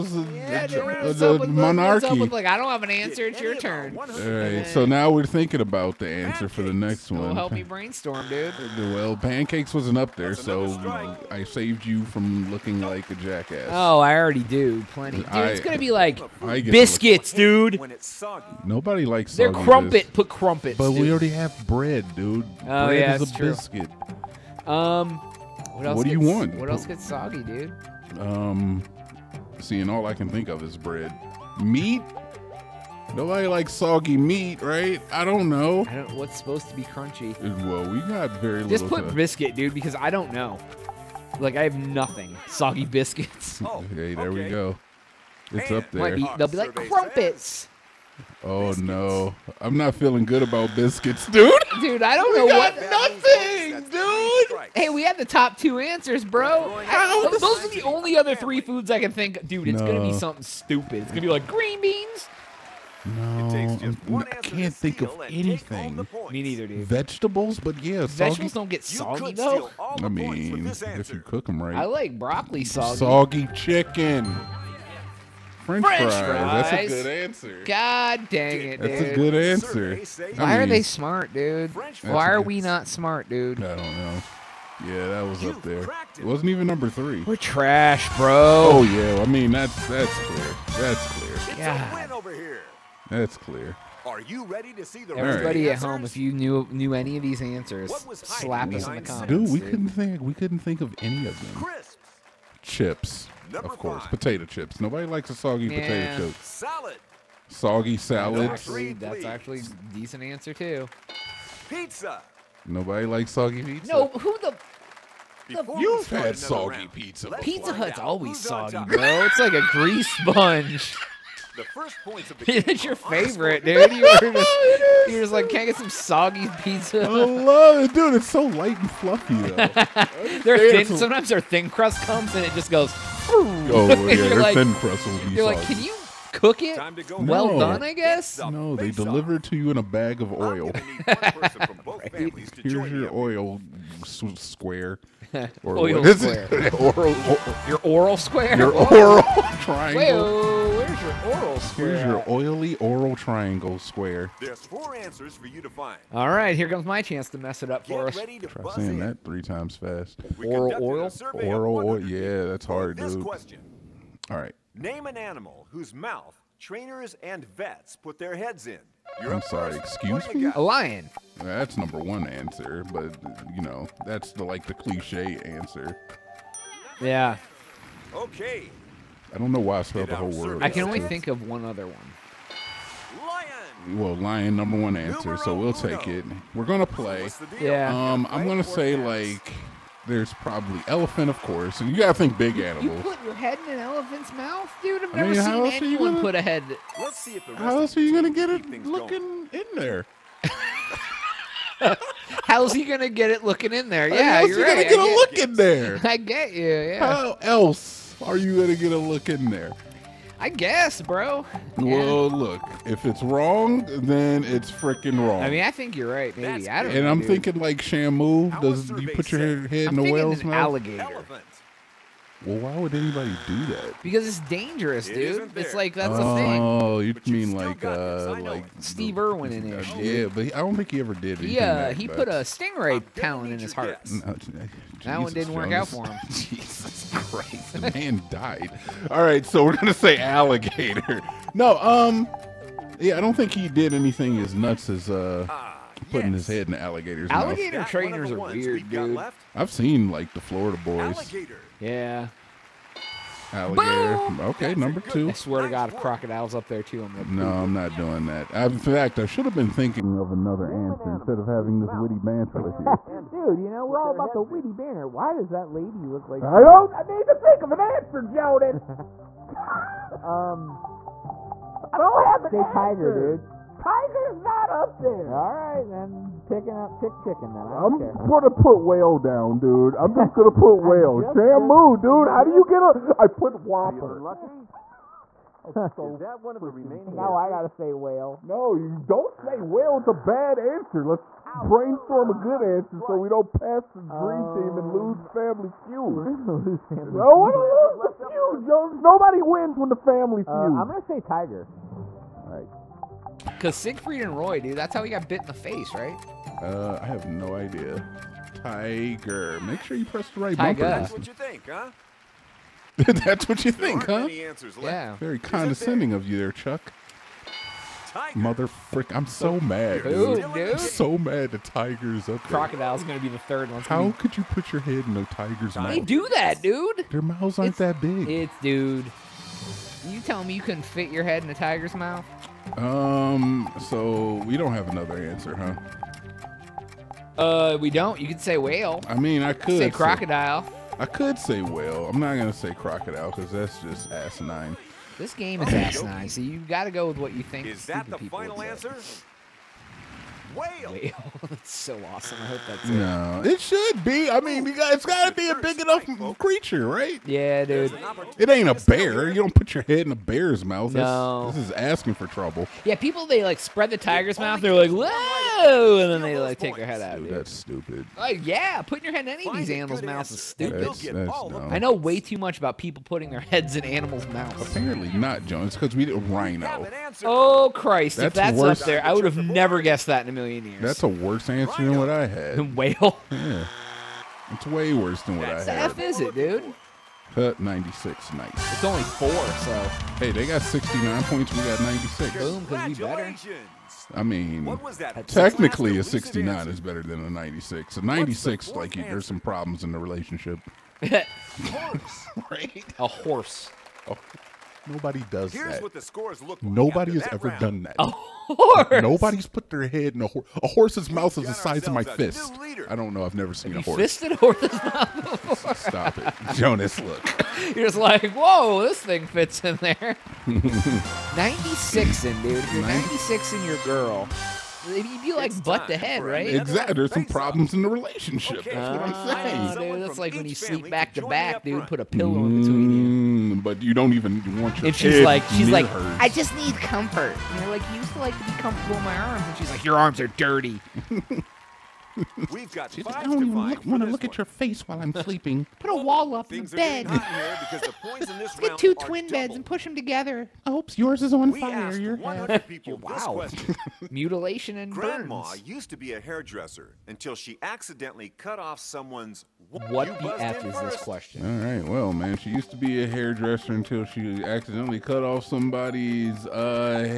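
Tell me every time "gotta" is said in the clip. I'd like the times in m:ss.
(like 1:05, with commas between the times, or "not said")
3:11, 4:47.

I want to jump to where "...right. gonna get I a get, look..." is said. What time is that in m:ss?
3:24.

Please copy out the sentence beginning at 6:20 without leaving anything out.
That's a worse answer than what I had.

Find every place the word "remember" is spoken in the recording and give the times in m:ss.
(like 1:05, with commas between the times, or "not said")
not said.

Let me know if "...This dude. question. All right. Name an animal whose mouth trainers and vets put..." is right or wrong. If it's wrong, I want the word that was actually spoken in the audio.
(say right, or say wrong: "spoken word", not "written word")
right.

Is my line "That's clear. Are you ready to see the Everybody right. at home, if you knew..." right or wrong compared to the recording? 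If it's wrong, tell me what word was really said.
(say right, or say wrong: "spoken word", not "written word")
right.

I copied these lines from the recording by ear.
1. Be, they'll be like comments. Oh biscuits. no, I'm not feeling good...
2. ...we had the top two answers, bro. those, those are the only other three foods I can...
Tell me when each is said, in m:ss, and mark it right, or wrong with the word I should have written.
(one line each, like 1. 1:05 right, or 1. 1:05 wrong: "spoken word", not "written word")
1. 0:46 wrong: "crumpets", not "comments"
2. 0:54 right.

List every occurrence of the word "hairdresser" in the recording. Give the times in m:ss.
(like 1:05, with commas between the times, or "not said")
7:36, 7:43.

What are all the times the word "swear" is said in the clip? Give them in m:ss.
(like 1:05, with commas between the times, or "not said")
4:15.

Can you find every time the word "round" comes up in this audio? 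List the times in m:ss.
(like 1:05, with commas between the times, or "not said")
1:56, 6:47.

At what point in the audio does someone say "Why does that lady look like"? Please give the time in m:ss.
4:25.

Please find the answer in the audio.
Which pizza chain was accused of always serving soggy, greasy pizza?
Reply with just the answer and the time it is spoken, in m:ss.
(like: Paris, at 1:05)
Pizza Hut, at 1:57.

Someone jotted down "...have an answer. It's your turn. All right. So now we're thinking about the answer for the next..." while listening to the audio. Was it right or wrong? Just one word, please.
right.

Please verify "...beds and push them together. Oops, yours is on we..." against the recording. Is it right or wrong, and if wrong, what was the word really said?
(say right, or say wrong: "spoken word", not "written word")
right.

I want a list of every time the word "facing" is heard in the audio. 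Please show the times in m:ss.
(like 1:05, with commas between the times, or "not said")
not said.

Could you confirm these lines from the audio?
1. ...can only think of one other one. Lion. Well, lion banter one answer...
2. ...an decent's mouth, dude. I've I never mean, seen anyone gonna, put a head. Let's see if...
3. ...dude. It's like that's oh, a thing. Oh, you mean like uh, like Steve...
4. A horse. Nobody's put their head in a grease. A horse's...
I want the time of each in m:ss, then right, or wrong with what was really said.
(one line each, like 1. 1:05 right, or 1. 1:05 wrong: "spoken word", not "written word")
1. 3:00 wrong: "number", not "banter"
2. 3:13 wrong: "elephant", not "decent"
3. 3:45 right
4. 6:47 wrong: "horse", not "grease".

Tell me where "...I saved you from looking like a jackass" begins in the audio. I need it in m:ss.
0:11.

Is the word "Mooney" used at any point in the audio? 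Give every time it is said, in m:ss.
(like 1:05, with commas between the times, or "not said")
not said.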